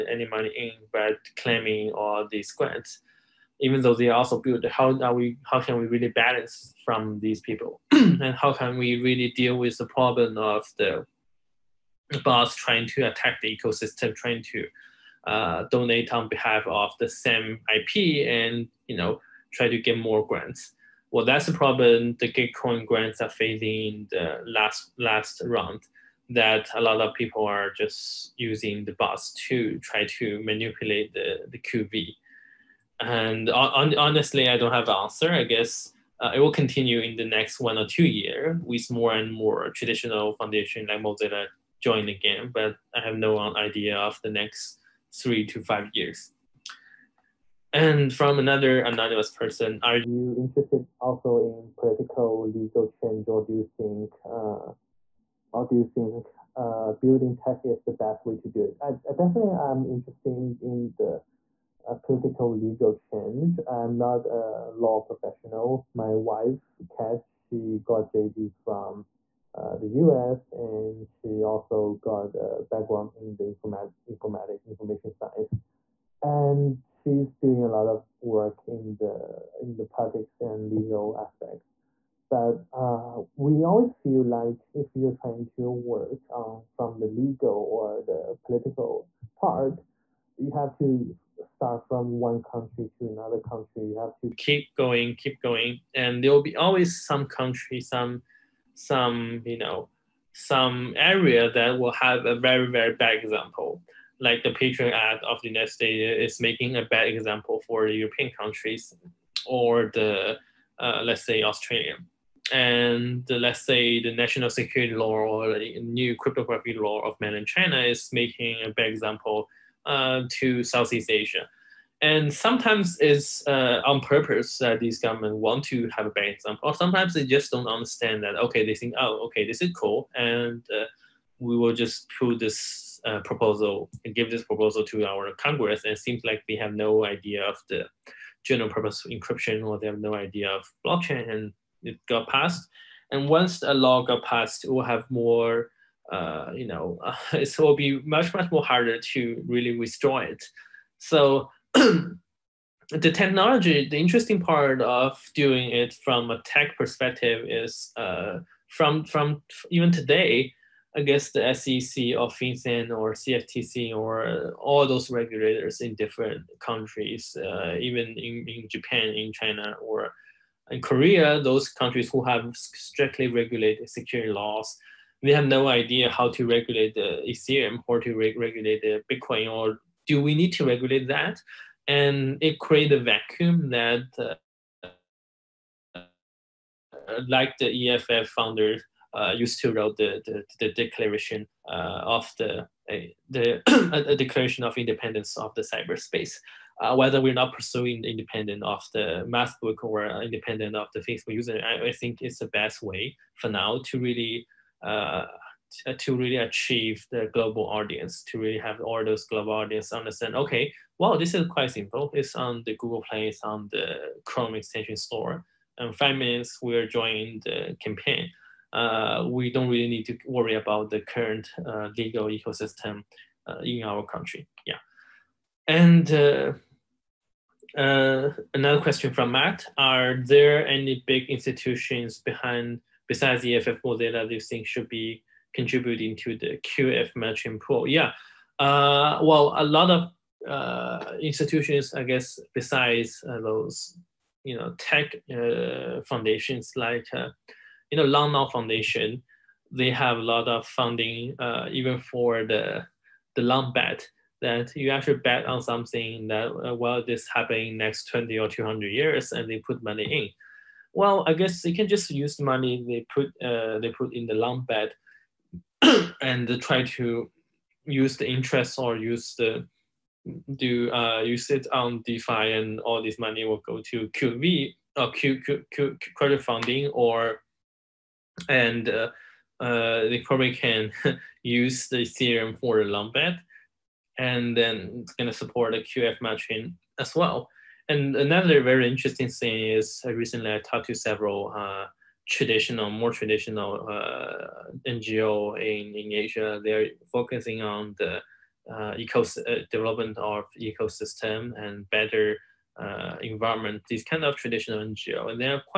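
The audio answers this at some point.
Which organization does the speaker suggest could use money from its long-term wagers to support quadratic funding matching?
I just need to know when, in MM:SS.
04:08.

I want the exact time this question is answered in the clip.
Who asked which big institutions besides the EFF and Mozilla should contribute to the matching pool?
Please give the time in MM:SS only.
03:49.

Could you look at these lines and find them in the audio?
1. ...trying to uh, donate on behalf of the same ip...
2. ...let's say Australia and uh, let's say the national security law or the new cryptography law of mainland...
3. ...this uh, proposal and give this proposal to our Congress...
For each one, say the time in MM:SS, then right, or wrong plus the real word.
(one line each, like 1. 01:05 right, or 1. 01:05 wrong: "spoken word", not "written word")
1. 00:14 right
2. 01:51 right
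3. 02:12 right.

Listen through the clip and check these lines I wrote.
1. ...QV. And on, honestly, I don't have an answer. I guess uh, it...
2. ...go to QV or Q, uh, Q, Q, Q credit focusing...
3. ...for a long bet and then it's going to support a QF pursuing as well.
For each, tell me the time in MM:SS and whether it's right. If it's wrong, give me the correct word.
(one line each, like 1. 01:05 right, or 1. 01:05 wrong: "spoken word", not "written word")
1. 00:31 right
2. 04:33 wrong: "funding", not "focusing"
3. 04:42 wrong: "matching", not "pursuing".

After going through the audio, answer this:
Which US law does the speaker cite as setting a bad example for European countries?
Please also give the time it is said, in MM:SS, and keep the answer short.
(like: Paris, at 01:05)
Patriot Act, at 01:44.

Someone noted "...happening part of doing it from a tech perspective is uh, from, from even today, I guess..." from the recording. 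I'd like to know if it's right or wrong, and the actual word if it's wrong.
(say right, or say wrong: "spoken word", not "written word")
wrong: "interesting", not "happening".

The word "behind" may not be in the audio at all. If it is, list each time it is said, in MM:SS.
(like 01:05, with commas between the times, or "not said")
03:52.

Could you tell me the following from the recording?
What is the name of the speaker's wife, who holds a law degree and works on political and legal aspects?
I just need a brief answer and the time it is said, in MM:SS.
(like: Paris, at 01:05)
Kat, at 01:06.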